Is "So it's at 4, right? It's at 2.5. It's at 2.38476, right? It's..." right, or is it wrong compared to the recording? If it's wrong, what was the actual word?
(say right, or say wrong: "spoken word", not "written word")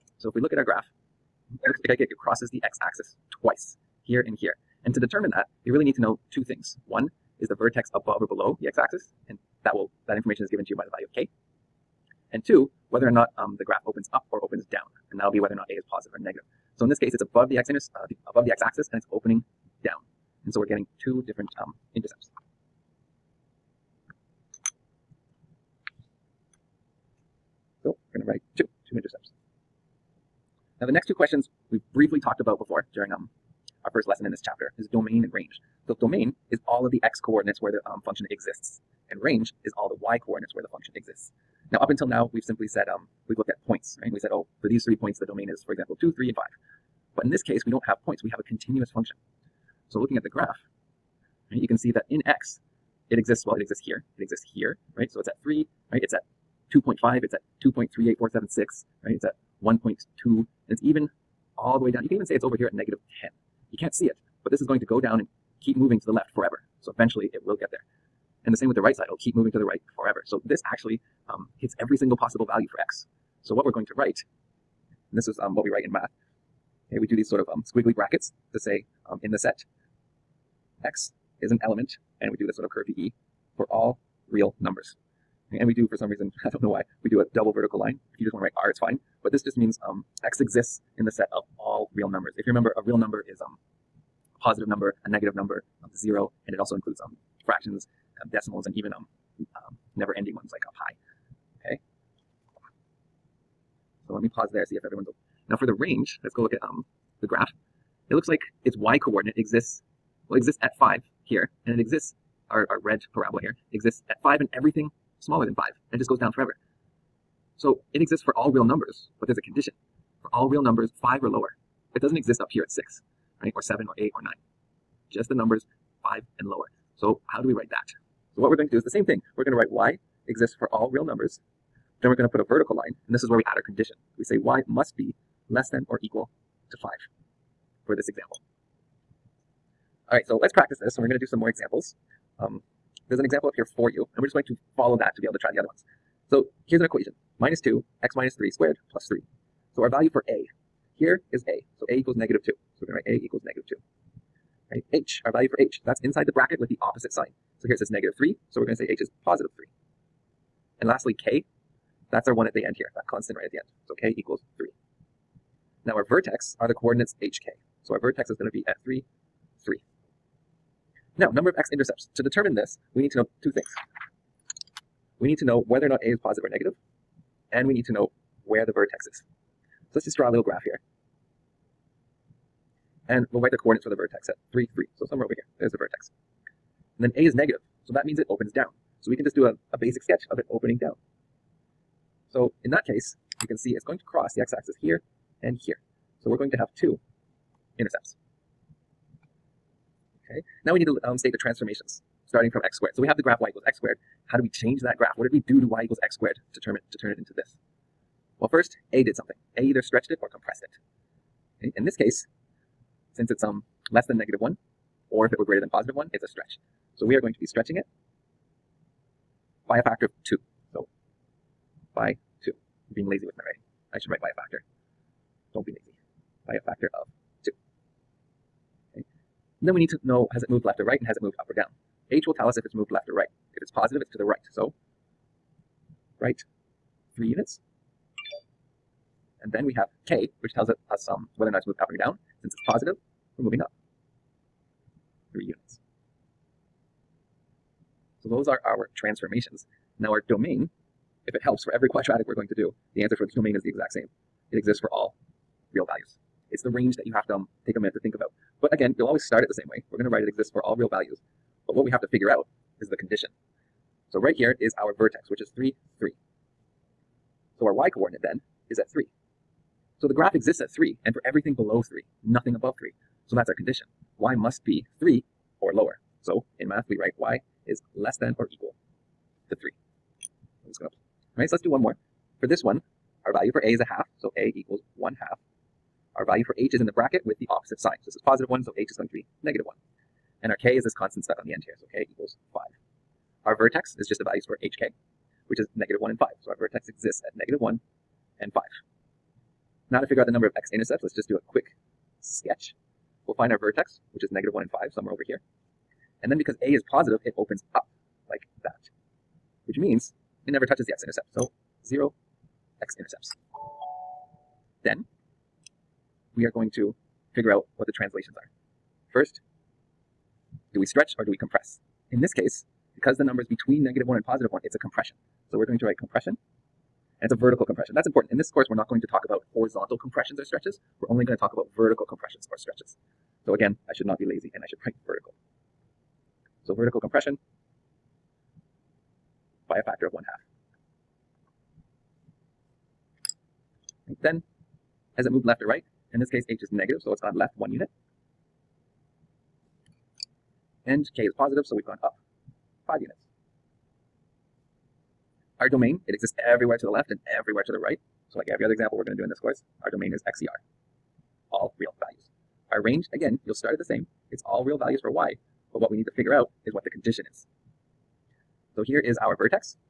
wrong: "3", not "4".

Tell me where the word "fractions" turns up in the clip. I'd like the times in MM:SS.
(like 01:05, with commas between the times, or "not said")
01:37.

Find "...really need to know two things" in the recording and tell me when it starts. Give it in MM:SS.
00:05.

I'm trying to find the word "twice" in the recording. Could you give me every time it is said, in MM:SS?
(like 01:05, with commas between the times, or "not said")
00:03.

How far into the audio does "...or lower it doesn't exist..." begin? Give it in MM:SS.
02:01.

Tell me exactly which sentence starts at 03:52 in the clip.
H will tell us if it's moved left or right.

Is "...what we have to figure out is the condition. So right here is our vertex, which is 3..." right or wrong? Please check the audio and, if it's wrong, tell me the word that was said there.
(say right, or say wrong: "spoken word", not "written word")
right.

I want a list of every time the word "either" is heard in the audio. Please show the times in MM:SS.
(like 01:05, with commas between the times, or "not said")
03:29.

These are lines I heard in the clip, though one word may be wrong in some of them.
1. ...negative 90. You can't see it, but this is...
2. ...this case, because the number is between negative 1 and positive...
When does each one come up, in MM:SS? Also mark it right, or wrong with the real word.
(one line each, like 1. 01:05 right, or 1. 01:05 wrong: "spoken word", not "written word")
1. 01:02 wrong: "10", not "90"
2. 05:22 right.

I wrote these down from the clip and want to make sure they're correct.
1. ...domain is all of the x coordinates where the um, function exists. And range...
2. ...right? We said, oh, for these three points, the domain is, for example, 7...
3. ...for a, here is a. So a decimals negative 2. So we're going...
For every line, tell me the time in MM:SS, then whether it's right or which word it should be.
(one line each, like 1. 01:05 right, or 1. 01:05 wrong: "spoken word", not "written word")
1. 00:35 right
2. 00:43 wrong: "2", not "7"
3. 02:30 wrong: "equals", not "decimals".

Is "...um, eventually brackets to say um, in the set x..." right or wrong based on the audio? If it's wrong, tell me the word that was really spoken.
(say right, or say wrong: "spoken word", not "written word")
wrong: "squiggly", not "eventually".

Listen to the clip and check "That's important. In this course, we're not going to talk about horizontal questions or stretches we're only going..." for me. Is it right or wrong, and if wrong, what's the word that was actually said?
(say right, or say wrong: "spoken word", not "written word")
wrong: "compressions", not "questions".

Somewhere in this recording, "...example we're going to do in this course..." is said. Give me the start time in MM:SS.
05:58.